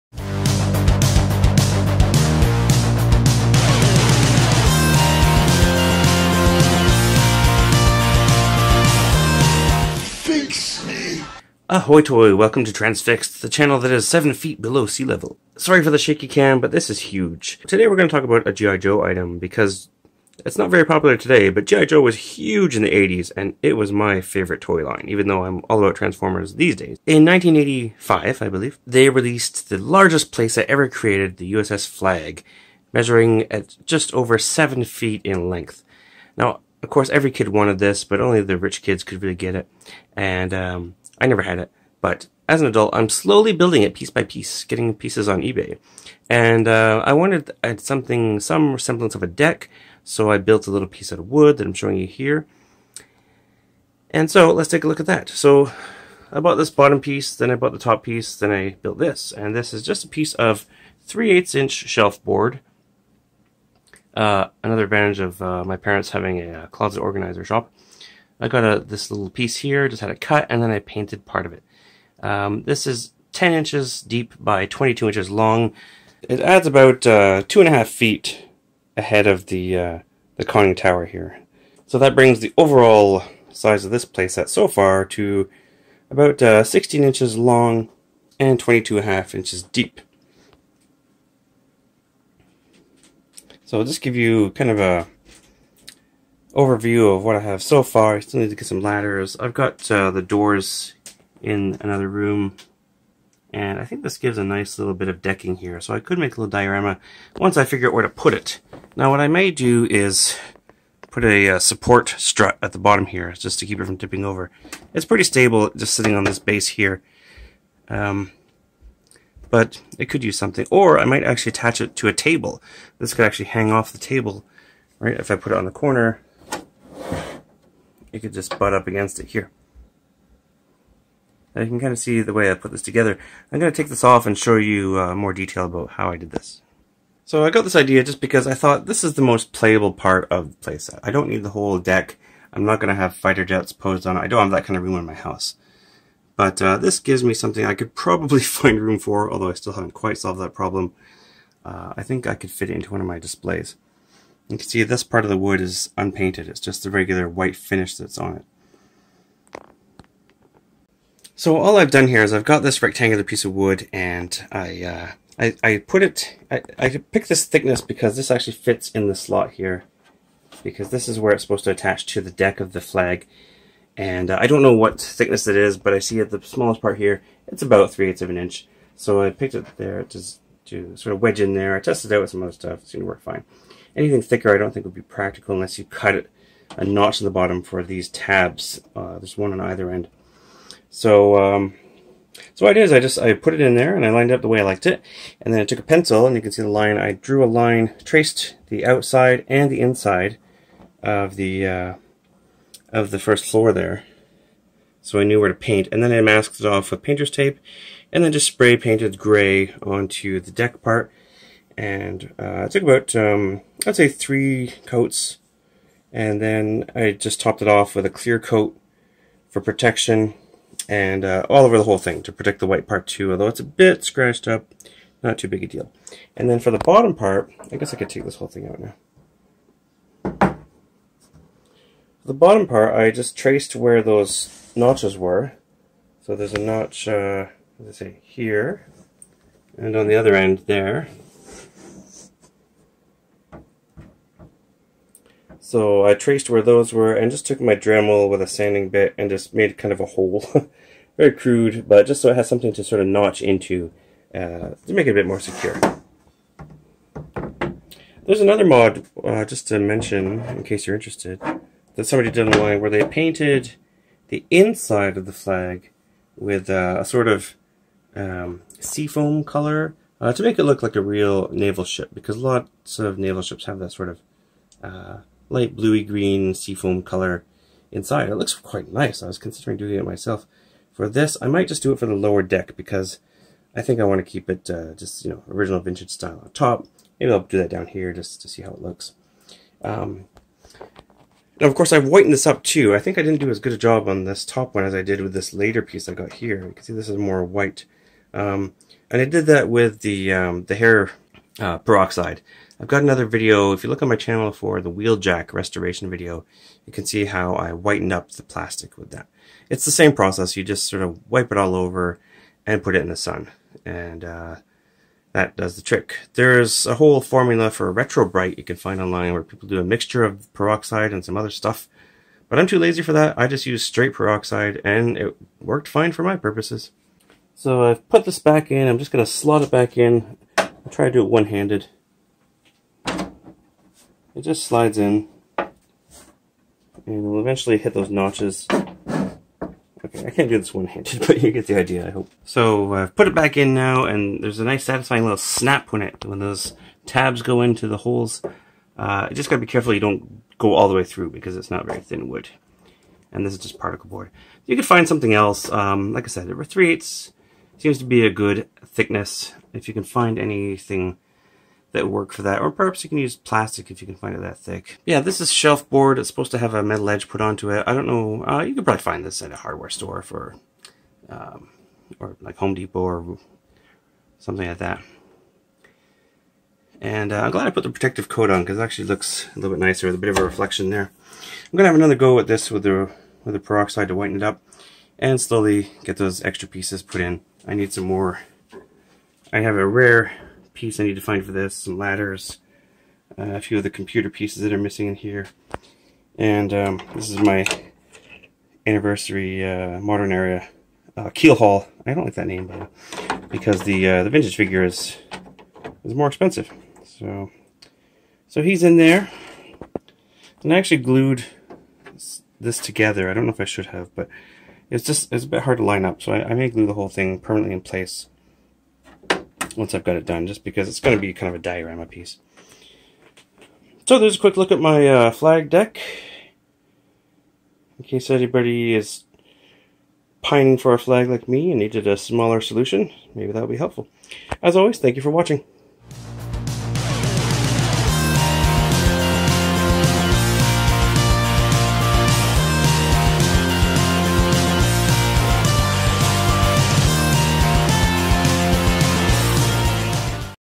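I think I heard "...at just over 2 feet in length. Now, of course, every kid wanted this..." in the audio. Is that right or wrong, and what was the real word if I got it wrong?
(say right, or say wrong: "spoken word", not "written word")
wrong: "7", not "2".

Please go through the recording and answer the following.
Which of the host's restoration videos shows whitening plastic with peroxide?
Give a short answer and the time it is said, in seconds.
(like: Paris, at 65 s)
Wheeljack restoration, at 304 s.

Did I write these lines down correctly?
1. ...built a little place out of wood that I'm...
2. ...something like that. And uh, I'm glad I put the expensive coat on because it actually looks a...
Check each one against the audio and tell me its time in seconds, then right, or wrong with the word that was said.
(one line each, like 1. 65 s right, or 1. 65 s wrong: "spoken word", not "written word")
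1. 50 s wrong: "piece", not "place"
2. 374 s wrong: "protective", not "expensive".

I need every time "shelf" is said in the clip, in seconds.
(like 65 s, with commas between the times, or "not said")
61 s, 365 s.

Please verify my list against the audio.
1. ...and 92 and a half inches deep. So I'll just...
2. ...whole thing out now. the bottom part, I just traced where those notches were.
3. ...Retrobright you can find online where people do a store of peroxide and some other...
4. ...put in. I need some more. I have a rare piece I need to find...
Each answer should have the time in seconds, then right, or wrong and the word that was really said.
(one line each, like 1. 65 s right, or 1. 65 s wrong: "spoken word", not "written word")
1. 88 s wrong: "22", not "92"
2. 228 s right
3. 317 s wrong: "mixture", not "store"
4. 387 s right.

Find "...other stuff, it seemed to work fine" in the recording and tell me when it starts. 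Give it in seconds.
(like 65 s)
182 s.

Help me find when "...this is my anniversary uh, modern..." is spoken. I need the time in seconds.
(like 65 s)
397 s.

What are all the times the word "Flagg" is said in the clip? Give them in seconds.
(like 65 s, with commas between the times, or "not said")
31 s, 172 s, 265 s, 425 s, 430 s.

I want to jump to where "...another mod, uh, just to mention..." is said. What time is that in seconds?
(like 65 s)
258 s.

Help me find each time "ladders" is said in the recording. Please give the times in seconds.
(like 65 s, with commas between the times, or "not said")
98 s, 391 s.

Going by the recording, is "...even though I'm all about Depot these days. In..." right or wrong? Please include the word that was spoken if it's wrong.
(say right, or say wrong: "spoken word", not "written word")
wrong: "Transformers", not "Depot".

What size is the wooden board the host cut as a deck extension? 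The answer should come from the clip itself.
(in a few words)
10 inches deep by 22 inches long.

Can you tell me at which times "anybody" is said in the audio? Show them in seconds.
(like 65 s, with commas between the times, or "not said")
428 s.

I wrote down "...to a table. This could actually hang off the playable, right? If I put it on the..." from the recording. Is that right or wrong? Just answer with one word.
wrong.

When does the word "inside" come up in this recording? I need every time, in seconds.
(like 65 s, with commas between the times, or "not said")
199 s, 264 s, 277 s.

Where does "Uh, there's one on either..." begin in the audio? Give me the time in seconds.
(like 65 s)
188 s.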